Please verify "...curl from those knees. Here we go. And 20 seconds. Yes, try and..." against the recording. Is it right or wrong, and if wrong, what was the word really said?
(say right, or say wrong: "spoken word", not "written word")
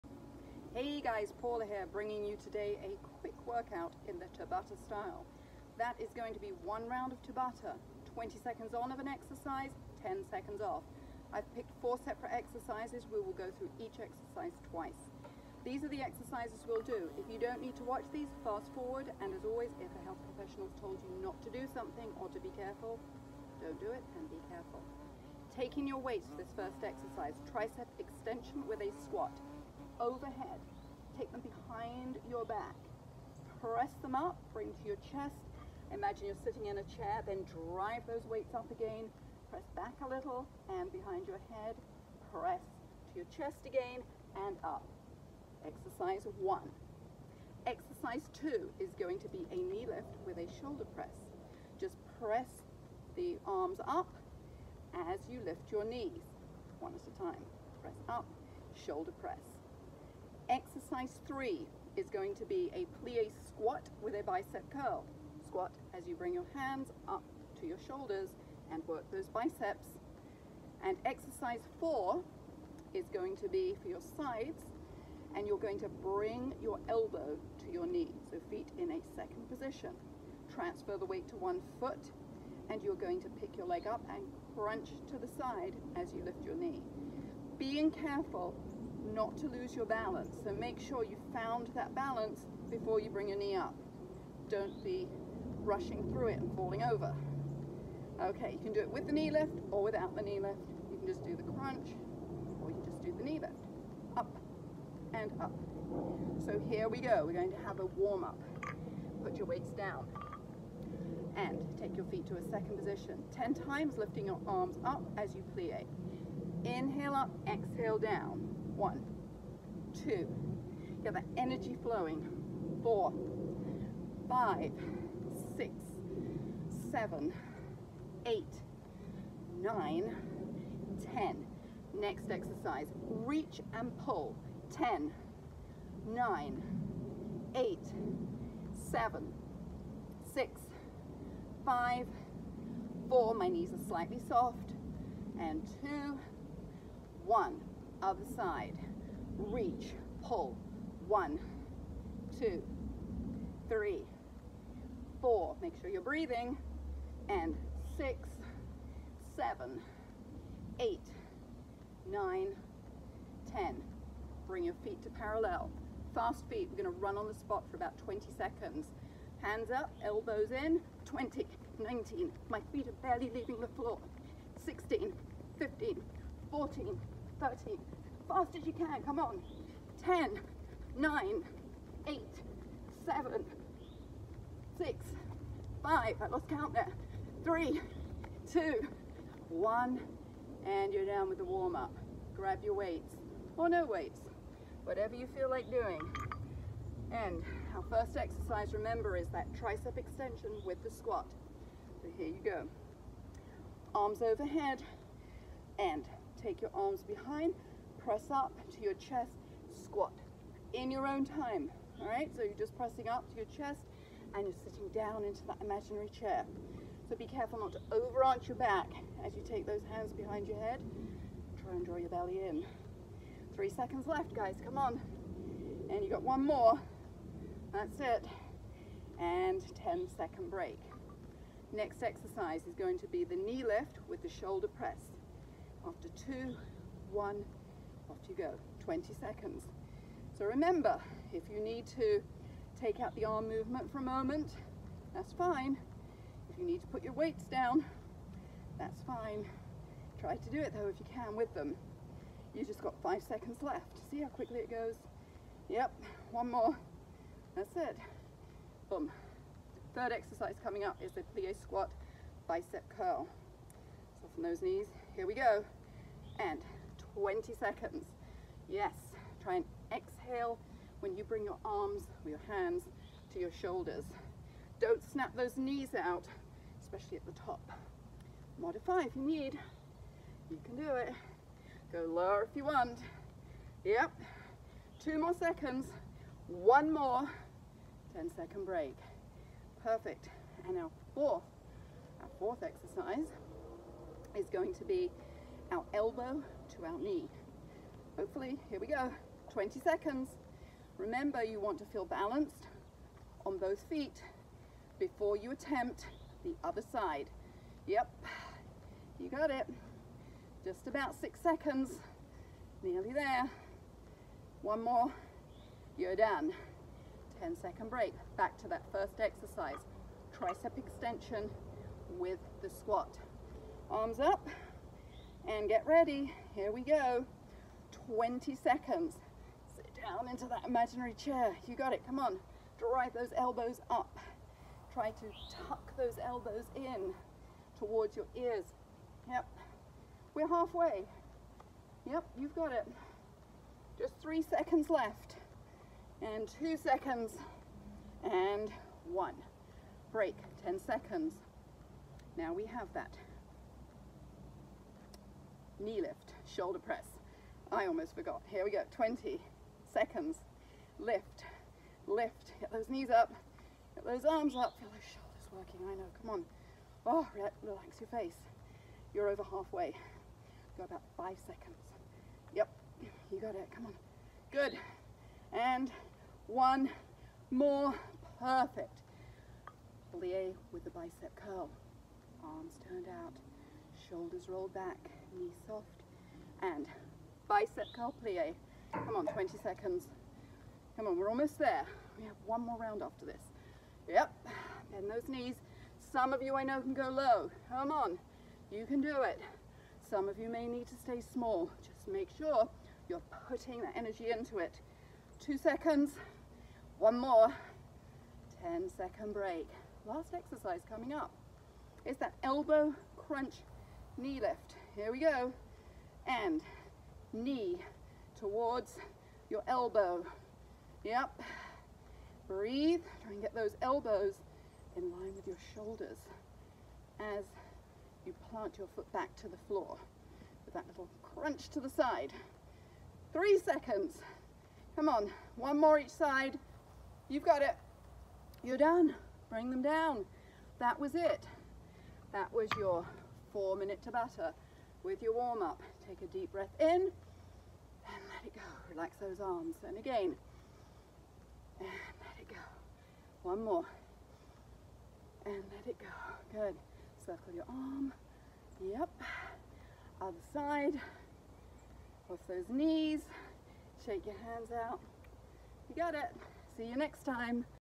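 right.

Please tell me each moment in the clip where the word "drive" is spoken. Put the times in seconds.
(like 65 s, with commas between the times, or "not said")
37 s, 332 s.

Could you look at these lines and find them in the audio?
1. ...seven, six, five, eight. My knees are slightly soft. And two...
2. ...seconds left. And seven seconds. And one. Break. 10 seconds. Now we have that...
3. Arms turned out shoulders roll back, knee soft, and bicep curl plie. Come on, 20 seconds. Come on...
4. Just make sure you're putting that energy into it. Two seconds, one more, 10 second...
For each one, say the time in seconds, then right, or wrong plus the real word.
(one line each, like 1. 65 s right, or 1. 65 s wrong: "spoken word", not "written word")
1. 138 s wrong: "four", not "eight"
2. 344 s wrong: "two", not "seven"
3. 382 s right
4. 401 s right.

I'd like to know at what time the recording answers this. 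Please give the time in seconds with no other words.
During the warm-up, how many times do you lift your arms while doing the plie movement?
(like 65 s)
113 s.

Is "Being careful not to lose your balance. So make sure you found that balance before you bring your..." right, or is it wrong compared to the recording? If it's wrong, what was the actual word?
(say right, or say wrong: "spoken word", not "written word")
right.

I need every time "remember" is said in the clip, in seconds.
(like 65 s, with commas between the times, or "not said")
198 s, 240 s, 300 s.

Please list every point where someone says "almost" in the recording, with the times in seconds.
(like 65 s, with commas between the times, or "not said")
357 s, 391 s.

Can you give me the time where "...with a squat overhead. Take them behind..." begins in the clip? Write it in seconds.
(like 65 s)
28 s.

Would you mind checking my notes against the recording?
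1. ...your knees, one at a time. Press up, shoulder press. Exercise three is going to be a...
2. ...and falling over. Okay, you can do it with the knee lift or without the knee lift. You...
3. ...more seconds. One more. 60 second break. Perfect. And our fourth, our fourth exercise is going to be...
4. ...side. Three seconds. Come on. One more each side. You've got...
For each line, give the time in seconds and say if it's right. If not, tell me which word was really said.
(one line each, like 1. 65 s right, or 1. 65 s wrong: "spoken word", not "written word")
1. 55 s right
2. 96 s right
3. 285 s wrong: "10", not "60"
4. 431 s right.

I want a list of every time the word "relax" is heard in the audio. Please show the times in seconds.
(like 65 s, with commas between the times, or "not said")
367 s, 448 s.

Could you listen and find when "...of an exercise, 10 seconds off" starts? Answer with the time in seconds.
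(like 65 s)
8 s.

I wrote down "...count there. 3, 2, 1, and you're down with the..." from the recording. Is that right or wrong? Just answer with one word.
right.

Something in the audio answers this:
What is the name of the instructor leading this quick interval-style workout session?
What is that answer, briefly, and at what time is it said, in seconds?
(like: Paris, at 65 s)
Paula, at 1 s.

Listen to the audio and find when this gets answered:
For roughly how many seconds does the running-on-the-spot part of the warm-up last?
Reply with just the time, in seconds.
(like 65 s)
167 s.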